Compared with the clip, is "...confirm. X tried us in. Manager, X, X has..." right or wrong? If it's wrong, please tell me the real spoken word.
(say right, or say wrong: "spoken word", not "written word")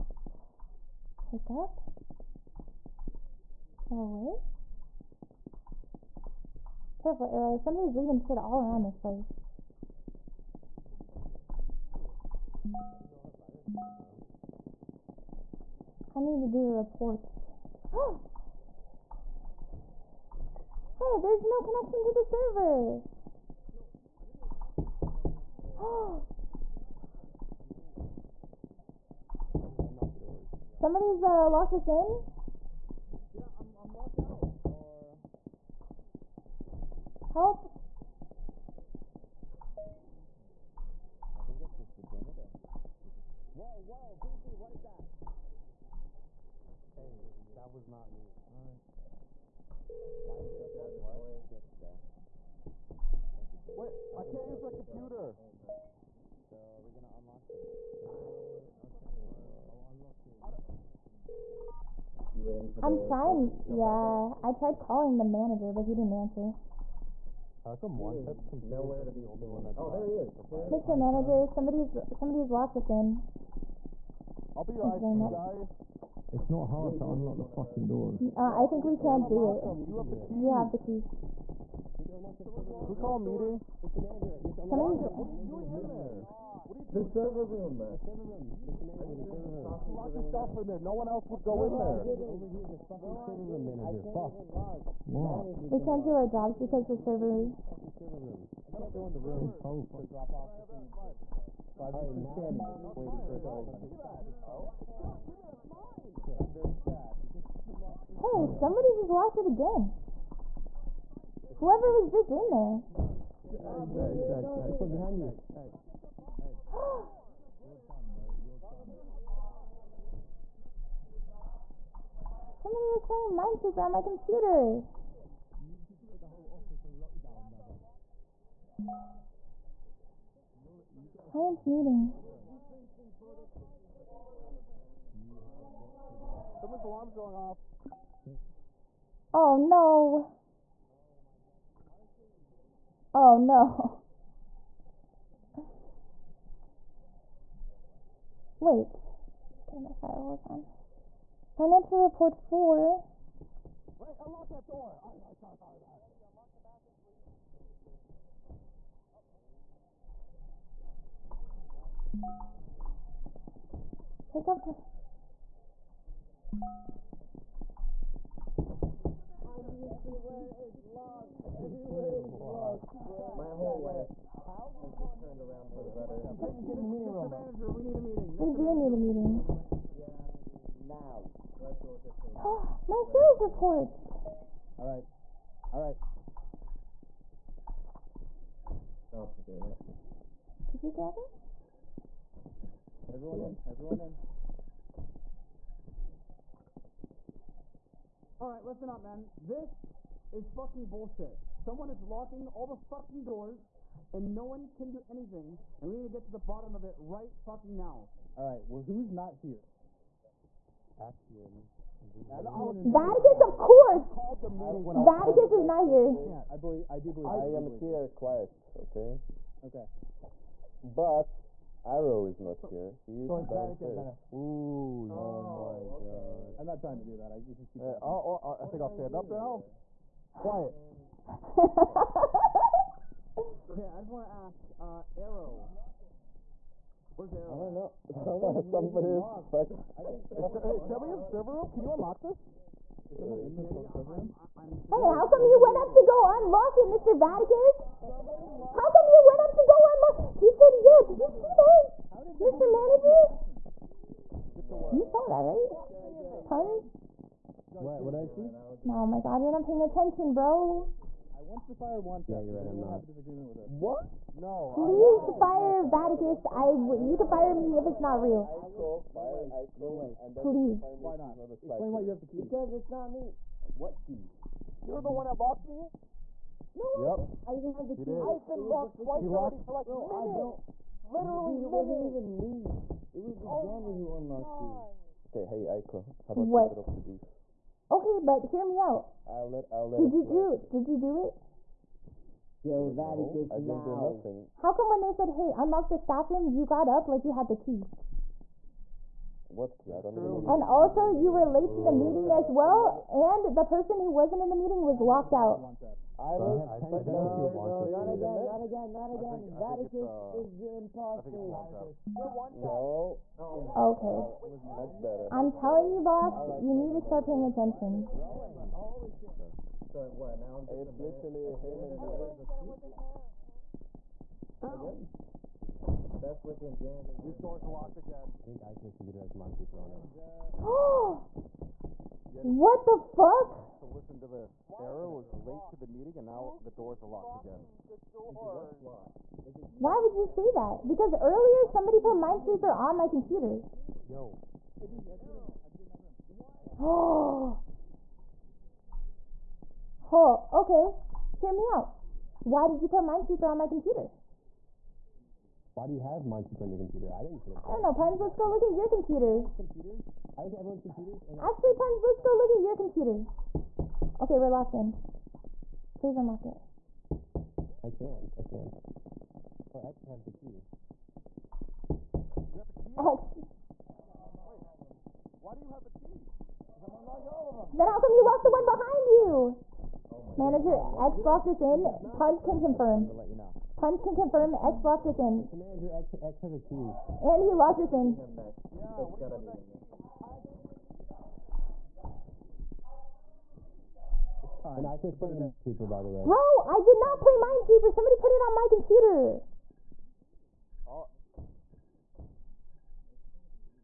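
wrong: "locked", not "tried".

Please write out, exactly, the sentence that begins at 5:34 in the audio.
Arrow was late to the meeting and now the doors are locked again.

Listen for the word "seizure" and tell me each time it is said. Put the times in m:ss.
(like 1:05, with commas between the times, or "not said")
not said.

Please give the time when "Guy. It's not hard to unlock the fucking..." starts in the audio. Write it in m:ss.
1:15.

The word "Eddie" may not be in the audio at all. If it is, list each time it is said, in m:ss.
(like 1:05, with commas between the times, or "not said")
2:36.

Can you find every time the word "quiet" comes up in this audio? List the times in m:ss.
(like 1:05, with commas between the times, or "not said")
3:38, 3:50.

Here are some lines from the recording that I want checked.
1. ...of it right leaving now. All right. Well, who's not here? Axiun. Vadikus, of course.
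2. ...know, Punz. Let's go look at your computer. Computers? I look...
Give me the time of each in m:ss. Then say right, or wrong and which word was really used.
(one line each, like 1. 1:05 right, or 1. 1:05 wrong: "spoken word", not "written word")
1. 3:26 wrong: "fucking", not "leaving"
2. 5:57 right.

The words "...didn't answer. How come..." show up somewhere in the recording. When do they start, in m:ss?
1:05.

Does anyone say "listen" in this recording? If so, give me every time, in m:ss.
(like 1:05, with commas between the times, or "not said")
3:18, 5:33.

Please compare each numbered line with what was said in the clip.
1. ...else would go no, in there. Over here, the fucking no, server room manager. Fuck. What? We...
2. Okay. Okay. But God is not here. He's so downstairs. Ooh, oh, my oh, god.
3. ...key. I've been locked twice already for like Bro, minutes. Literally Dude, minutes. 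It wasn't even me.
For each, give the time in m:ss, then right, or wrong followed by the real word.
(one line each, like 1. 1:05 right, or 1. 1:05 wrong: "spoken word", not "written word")
1. 1:31 right
2. 3:38 wrong: "Arrow", not "God"
3. 4:37 right.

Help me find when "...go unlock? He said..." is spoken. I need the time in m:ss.
4:09.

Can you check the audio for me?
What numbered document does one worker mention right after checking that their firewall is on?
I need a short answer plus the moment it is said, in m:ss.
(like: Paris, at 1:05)
Financial report four, at 2:31.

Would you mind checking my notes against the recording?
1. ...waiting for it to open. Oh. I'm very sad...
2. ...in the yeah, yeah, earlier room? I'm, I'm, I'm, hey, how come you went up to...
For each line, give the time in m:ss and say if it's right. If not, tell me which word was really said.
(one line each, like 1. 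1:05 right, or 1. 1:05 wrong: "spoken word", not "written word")
1. 1:42 right
2. 4:03 wrong: "server", not "earlier".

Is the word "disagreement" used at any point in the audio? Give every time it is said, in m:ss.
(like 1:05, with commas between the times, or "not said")
4:23.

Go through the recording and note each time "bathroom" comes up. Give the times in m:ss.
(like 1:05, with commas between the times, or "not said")
2:36.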